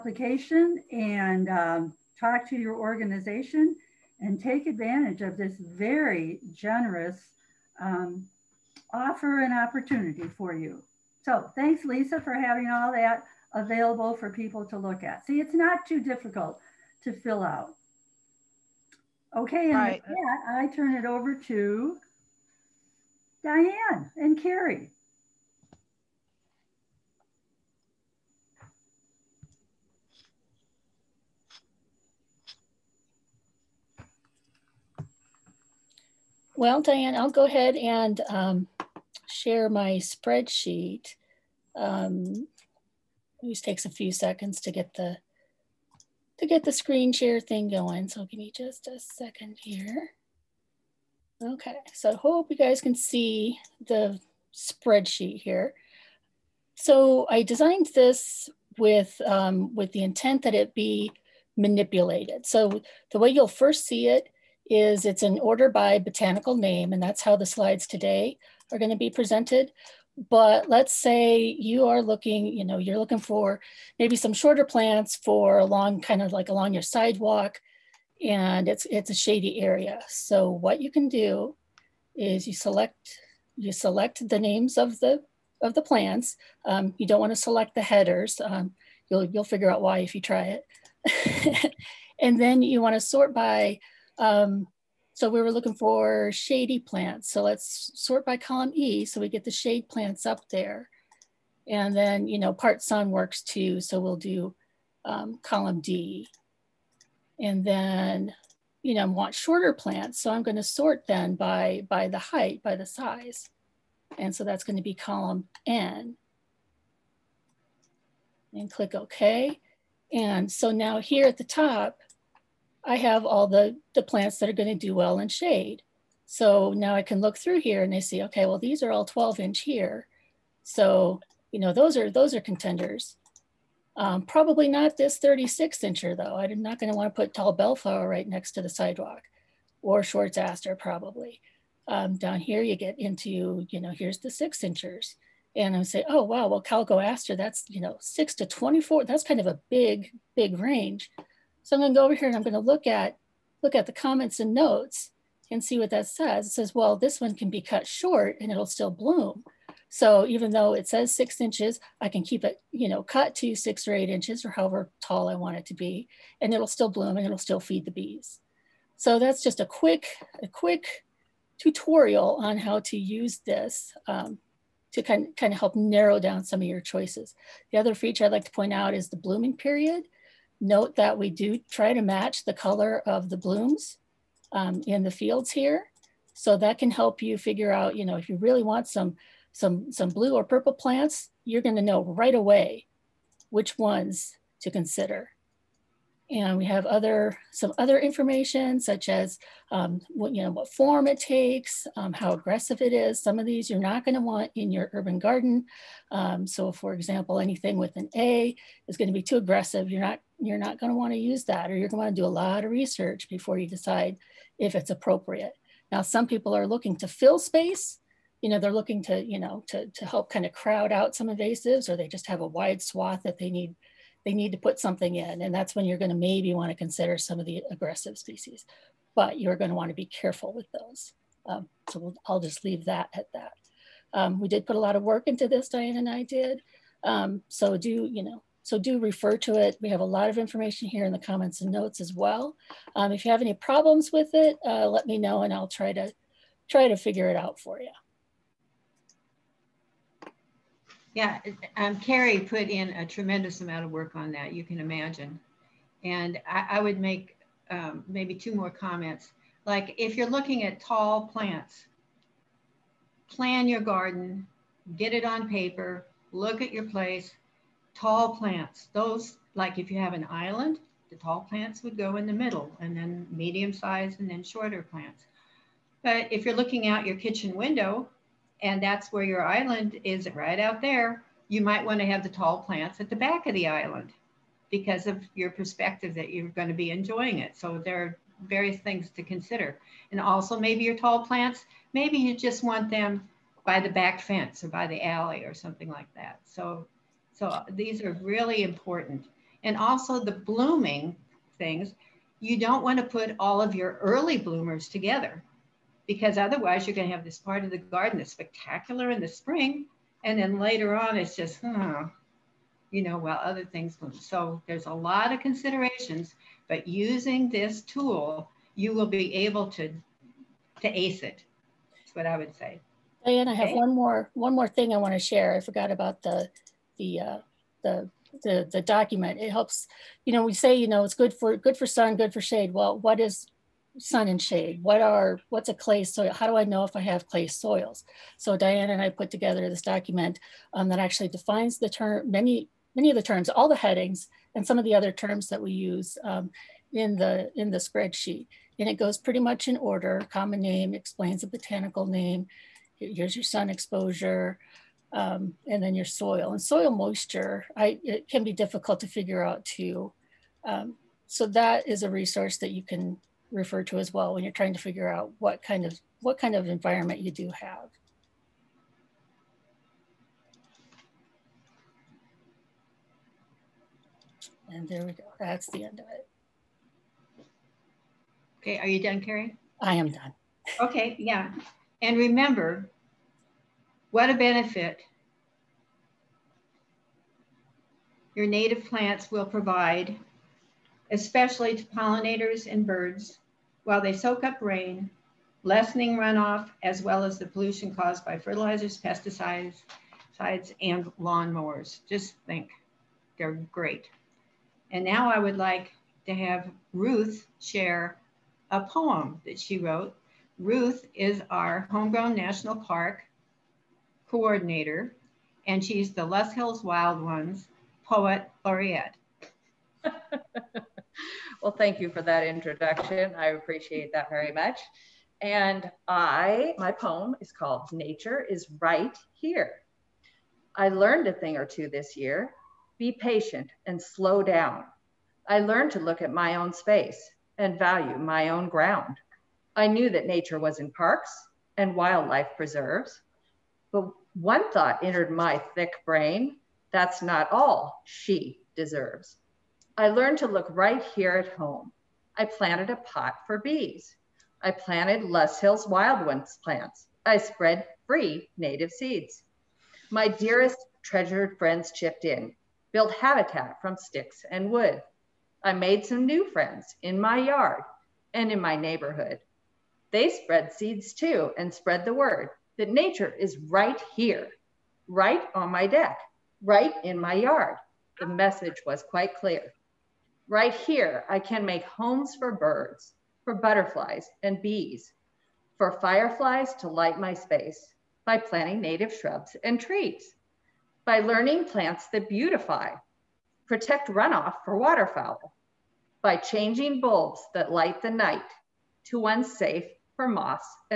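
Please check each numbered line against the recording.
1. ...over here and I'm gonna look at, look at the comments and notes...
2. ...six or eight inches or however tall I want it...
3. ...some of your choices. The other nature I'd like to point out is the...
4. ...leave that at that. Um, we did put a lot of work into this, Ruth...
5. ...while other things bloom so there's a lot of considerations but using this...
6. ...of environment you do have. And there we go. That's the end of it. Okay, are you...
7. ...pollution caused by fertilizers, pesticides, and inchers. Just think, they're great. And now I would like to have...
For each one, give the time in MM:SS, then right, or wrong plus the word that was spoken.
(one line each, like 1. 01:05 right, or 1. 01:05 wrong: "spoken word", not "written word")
1. 02:32 right
2. 02:43 right
3. 02:56 wrong: "feature", not "nature"
4. 03:52 wrong: "Diane", not "Ruth"
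5. 05:13 right
6. 06:06 right
7. 06:37 wrong: "lawnmowers", not "inchers".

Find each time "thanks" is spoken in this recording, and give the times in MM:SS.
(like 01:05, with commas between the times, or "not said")
00:11, 07:01.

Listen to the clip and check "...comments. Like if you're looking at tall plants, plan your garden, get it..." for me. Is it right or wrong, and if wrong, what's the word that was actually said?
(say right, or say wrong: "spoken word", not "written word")
right.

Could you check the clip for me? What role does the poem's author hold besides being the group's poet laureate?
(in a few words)
Homegrown national park coordinator.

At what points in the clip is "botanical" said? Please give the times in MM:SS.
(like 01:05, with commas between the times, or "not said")
01:05, 05:51.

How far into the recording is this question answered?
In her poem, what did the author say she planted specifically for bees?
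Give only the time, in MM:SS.
07:32.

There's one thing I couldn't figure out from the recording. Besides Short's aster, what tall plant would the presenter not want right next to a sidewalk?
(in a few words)
Tall bellflower.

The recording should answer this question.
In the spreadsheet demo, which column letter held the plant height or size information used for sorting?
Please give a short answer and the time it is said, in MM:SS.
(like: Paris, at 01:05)
Column N, at 01:54.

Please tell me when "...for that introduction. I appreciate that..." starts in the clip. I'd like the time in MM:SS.
07:02.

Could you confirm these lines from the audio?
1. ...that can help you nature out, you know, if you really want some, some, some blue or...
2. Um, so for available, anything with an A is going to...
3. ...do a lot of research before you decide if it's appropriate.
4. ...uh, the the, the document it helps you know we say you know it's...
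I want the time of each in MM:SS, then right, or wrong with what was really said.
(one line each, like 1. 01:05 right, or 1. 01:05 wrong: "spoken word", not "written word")
1. 03:06 wrong: "figure", not "nature"
2. 03:26 wrong: "example", not "available"
3. 03:32 right
4. 05:27 right.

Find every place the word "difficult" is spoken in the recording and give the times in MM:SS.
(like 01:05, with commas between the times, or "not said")
00:16, 05:58.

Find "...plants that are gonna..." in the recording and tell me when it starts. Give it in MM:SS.
02:04.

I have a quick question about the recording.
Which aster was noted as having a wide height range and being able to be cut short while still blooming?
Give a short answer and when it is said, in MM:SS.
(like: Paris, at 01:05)
Calico aster, at 02:26.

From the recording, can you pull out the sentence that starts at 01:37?
So let's sort by column E so we get the shade plants up there.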